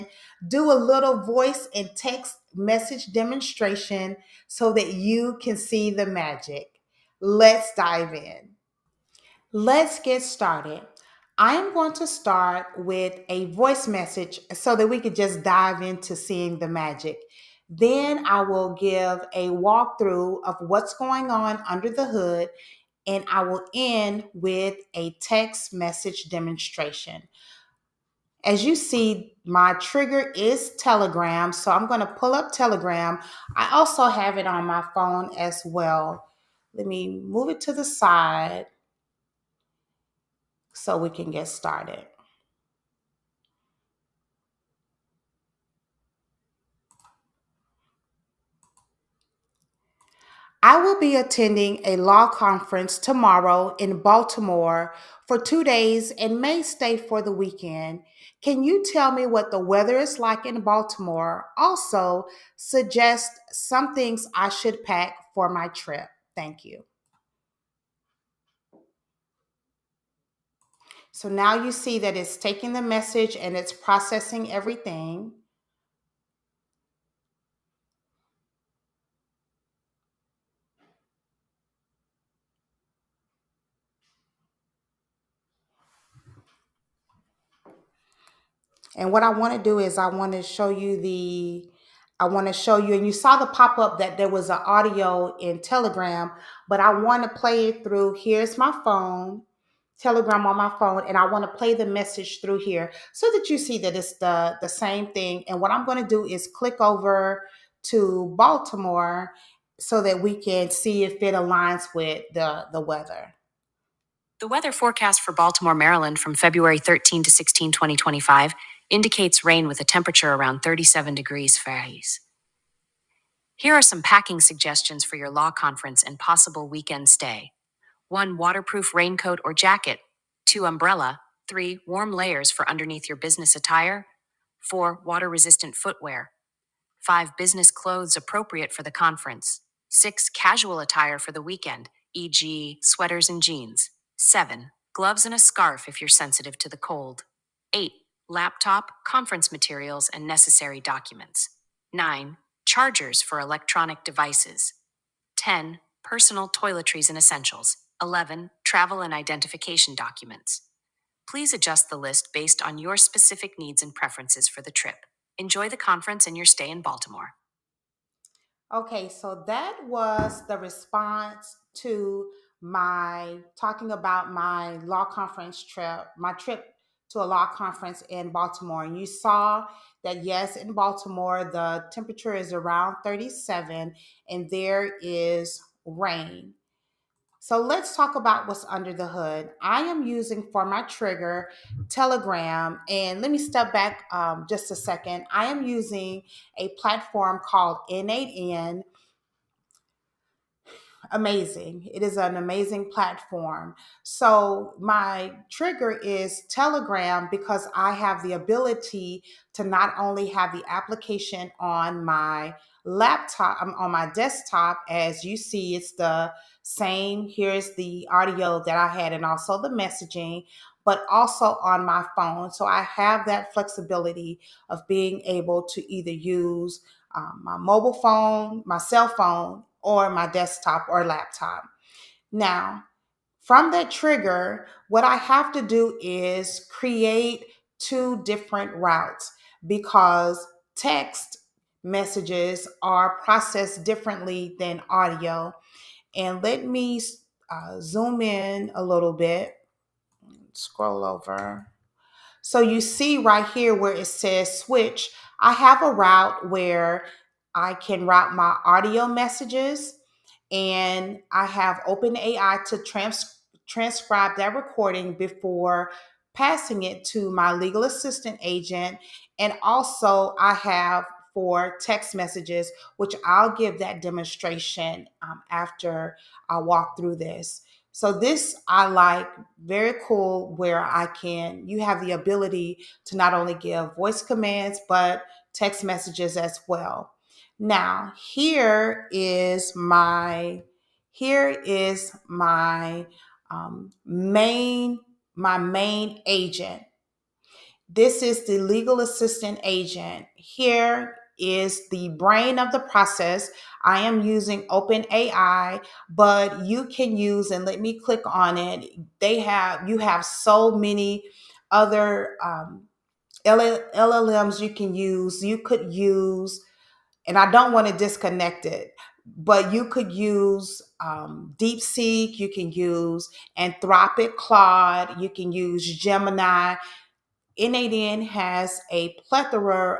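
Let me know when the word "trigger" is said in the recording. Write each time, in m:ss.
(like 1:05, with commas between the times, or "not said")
0:29, 3:10, 3:25, 3:53.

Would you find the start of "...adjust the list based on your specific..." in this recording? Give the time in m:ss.
2:41.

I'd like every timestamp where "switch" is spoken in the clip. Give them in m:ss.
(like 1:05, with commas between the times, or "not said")
4:14.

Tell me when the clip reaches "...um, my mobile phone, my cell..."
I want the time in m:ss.
3:47.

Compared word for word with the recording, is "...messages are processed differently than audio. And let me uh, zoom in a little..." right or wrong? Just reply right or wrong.
right.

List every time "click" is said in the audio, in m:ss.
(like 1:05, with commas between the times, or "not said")
1:46, 5:07.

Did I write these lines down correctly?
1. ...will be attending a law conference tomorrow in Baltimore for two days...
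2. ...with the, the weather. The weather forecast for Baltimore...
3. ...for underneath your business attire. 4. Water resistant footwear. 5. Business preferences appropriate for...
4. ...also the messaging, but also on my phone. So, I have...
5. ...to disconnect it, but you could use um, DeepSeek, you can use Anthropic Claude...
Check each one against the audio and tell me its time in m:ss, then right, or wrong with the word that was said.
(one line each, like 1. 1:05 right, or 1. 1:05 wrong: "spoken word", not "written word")
1. 0:50 right
2. 1:51 right
3. 2:12 wrong: "clothes", not "preferences"
4. 3:39 right
5. 5:17 right.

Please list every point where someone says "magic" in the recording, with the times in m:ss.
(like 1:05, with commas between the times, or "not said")
0:06, 0:16.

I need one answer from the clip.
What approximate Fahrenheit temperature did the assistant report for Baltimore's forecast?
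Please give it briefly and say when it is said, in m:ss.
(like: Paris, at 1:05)
37 degrees, at 2:00.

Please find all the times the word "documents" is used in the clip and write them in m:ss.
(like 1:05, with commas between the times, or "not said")
2:30, 2:39.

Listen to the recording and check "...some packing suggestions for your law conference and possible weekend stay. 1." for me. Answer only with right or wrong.
right.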